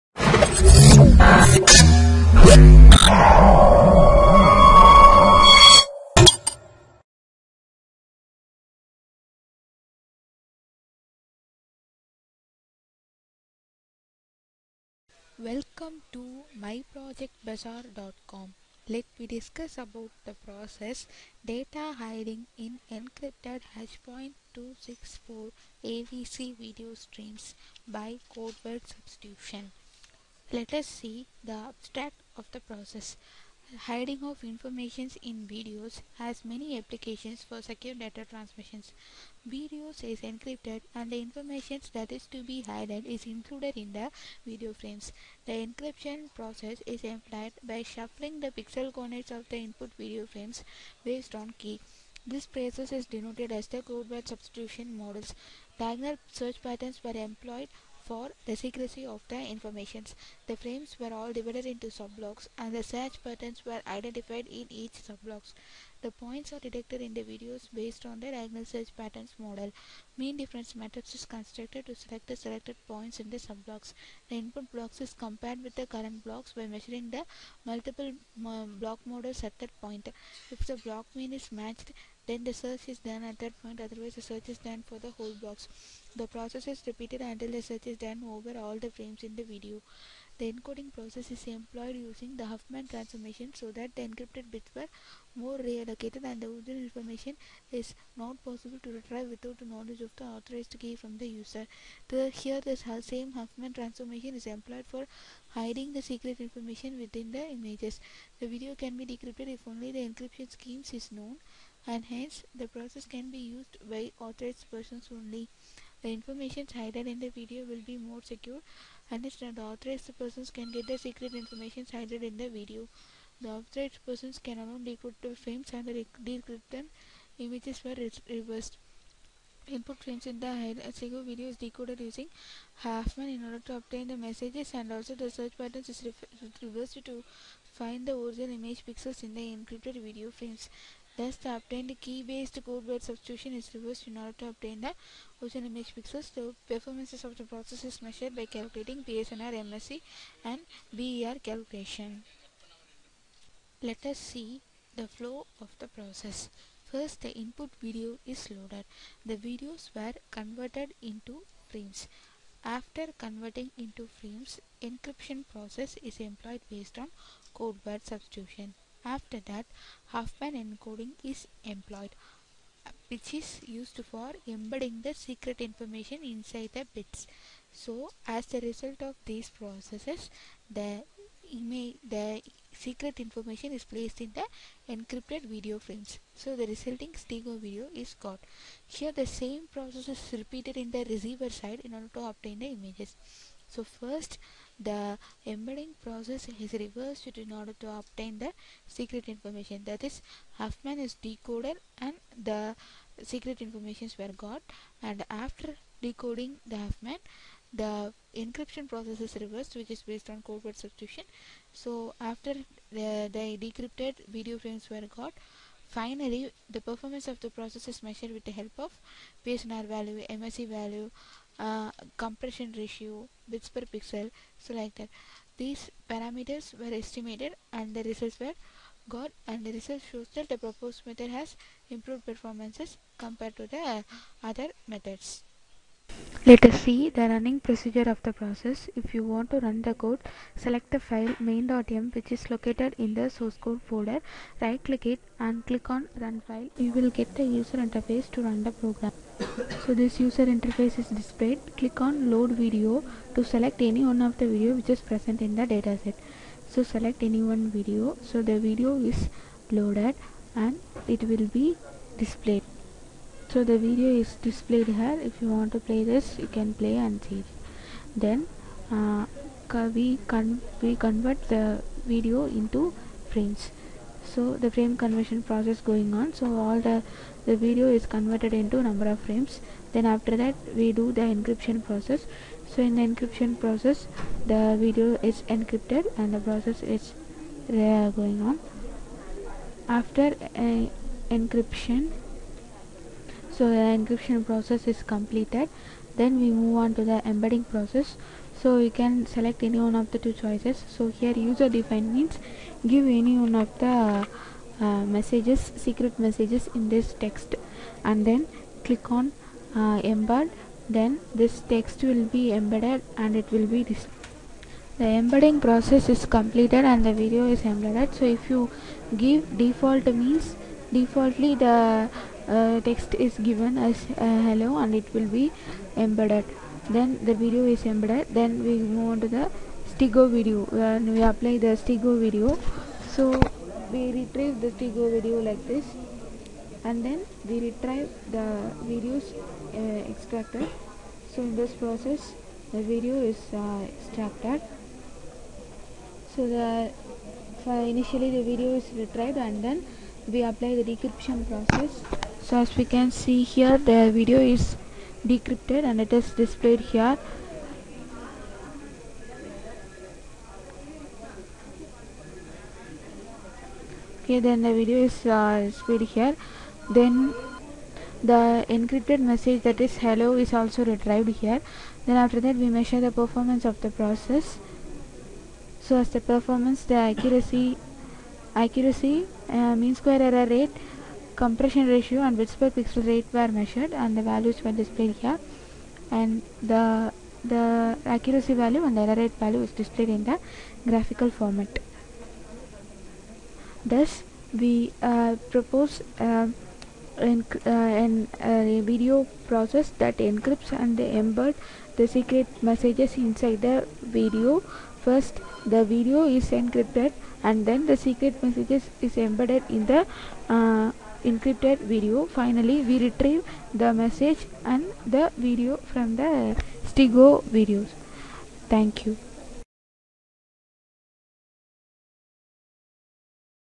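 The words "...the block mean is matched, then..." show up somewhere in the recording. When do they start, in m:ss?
1:20.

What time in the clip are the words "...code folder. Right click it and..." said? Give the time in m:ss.
4:03.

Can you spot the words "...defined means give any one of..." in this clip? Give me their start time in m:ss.
5:01.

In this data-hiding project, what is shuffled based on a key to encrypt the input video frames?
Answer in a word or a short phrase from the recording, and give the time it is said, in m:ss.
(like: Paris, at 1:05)
pixel coordinates, at 0:48.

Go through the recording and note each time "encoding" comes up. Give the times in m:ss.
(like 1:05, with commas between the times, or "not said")
1:30, 2:50.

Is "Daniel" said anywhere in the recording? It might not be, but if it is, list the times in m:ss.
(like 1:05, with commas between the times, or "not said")
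not said.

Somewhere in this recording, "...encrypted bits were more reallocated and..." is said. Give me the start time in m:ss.
1:34.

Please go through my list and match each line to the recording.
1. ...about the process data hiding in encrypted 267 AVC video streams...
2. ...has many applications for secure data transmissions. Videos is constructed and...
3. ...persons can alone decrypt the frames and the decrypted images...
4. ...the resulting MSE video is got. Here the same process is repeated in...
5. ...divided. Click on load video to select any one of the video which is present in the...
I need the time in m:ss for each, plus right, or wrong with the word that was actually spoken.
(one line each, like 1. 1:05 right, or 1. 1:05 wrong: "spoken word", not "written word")
1. 0:19 wrong: "264", not "267"
2. 0:36 wrong: "encrypted", not "constructed"
3. 2:04 right
4. 3:06 wrong: "Stego", not "MSE"
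5. 4:11 wrong: "displayed", not "divided".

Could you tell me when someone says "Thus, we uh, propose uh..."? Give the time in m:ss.
6:33.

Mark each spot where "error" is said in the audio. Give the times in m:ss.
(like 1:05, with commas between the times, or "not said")
6:20, 6:28.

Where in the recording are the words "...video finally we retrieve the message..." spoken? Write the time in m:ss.
6:51.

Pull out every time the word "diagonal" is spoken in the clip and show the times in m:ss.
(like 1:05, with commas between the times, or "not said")
0:55, 1:08.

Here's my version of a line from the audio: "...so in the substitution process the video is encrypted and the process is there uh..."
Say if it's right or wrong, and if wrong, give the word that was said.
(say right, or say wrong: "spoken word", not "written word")
wrong: "encryption", not "substitution".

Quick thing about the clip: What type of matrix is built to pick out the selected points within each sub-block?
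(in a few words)
Mean difference matrix.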